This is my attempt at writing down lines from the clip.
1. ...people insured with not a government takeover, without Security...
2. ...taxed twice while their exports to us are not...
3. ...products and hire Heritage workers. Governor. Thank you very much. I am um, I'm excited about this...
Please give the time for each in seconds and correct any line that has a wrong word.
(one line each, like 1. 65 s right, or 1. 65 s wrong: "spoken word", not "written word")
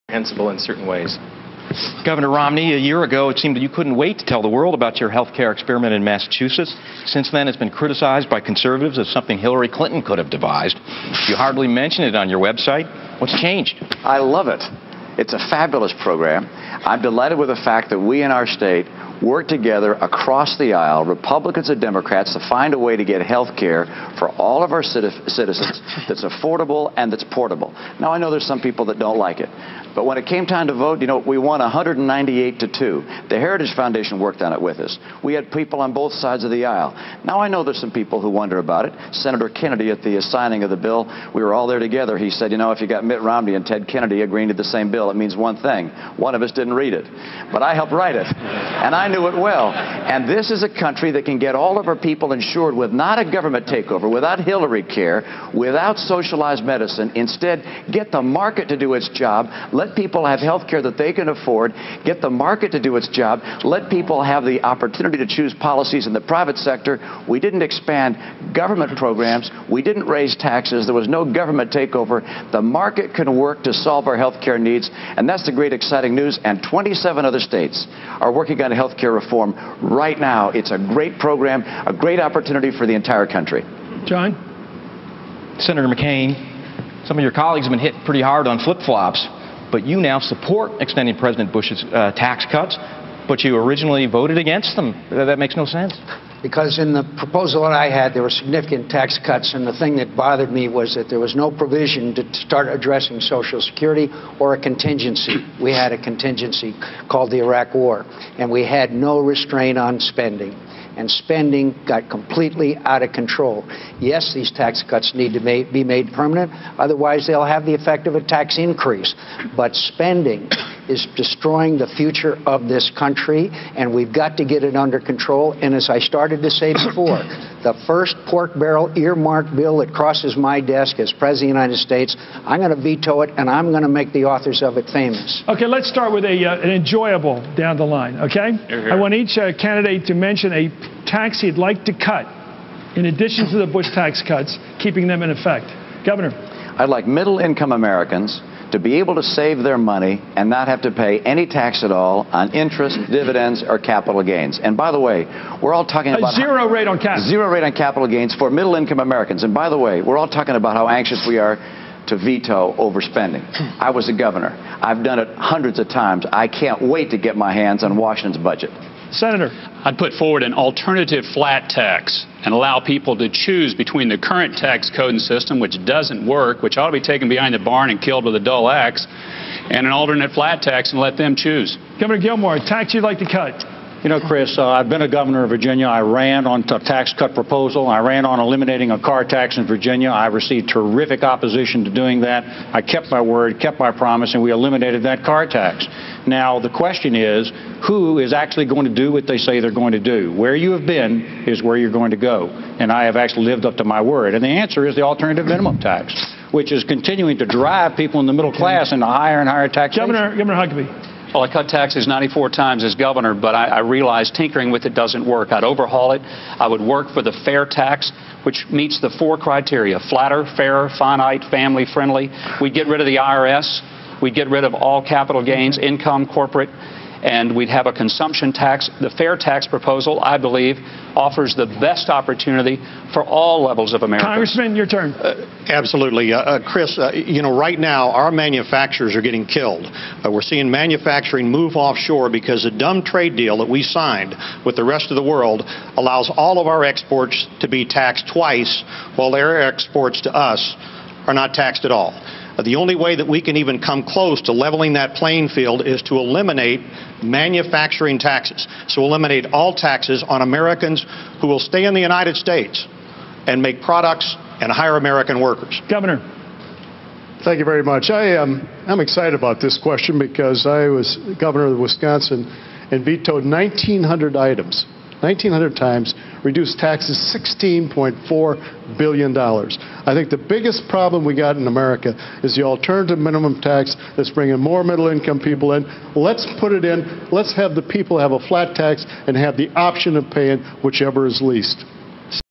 1. 51 s wrong: "Hillary", not "Security"
2. 247 s right
3. 263 s wrong: "American", not "Heritage".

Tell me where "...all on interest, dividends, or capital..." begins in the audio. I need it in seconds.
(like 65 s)
151 s.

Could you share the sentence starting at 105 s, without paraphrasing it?
We had a contingency called the Iraq War, and we had no restraint on spending.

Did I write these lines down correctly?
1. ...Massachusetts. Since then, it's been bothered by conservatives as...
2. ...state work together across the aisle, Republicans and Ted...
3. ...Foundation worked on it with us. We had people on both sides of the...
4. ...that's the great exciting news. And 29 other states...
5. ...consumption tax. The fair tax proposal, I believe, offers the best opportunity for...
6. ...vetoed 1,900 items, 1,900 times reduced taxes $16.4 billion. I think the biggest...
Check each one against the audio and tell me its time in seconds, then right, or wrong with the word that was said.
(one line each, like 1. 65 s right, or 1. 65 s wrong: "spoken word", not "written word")
1. 6 s wrong: "criticized", not "bothered"
2. 18 s wrong: "Democrats", not "Ted"
3. 33 s right
4. 75 s wrong: "27", not "29"
5. 227 s right
6. 273 s right.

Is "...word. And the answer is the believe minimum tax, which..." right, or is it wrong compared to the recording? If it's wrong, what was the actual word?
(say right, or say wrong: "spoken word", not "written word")
wrong: "alternative", not "believe".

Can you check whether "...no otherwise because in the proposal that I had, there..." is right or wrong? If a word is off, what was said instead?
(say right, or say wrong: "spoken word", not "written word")
wrong: "sense", not "otherwise".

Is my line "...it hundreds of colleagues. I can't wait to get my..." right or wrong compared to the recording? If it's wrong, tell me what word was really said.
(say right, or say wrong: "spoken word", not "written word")
wrong: "times", not "colleagues".